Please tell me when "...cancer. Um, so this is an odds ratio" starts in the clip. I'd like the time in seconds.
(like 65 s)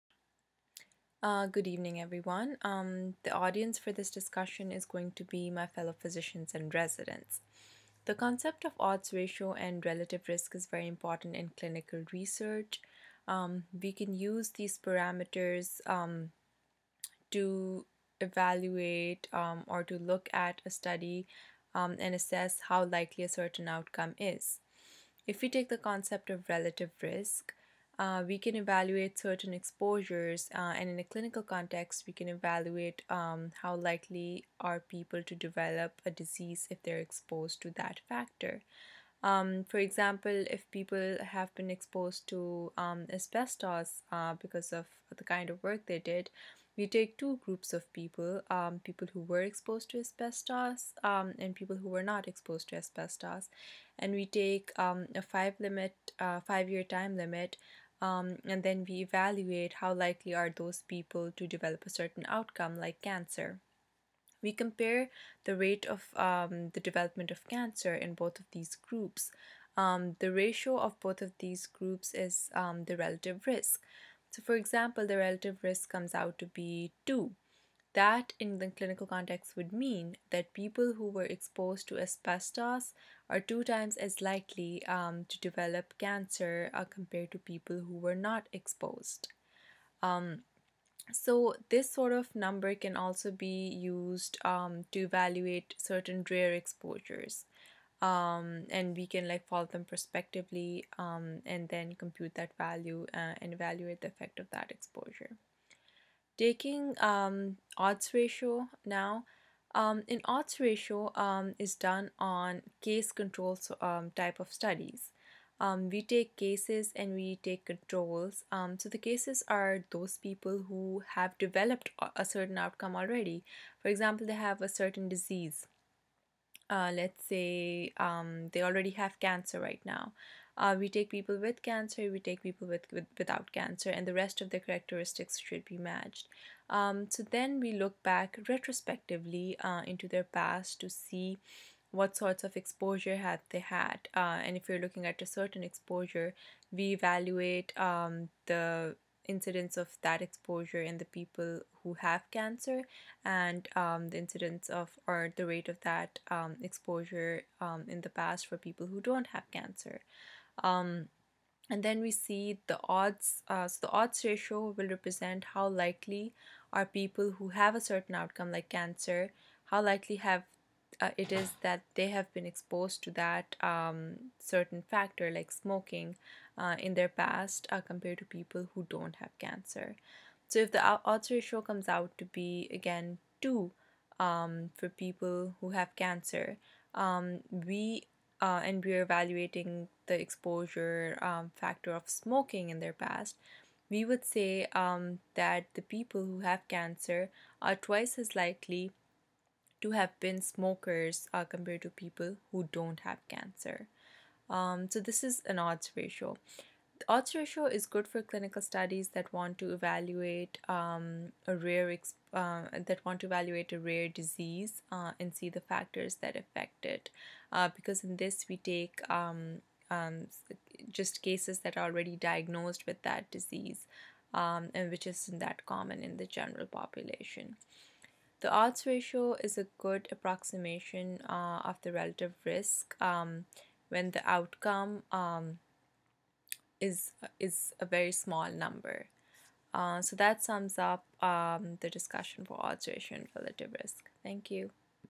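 203 s.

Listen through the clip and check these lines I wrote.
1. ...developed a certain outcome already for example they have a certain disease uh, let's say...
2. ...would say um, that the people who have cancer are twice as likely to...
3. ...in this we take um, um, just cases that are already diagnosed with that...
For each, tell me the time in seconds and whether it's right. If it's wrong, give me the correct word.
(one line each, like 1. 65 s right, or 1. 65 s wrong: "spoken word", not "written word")
1. 121 s right
2. 194 s right
3. 218 s right.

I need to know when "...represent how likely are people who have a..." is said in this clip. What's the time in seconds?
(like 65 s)
164 s.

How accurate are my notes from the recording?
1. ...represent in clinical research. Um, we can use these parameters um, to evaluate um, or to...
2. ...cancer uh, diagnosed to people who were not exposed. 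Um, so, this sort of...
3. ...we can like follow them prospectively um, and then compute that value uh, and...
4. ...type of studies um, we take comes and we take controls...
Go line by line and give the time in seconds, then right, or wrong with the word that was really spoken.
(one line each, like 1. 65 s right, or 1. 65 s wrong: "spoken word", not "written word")
1. 10 s wrong: "important", not "represent"
2. 85 s wrong: "compared", not "diagnosed"
3. 98 s right
4. 114 s wrong: "cases", not "comes".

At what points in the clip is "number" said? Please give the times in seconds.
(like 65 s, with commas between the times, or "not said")
92 s, 238 s.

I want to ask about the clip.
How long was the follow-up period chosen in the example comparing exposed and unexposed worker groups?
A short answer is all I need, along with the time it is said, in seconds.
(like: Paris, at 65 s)
5 years, at 56 s.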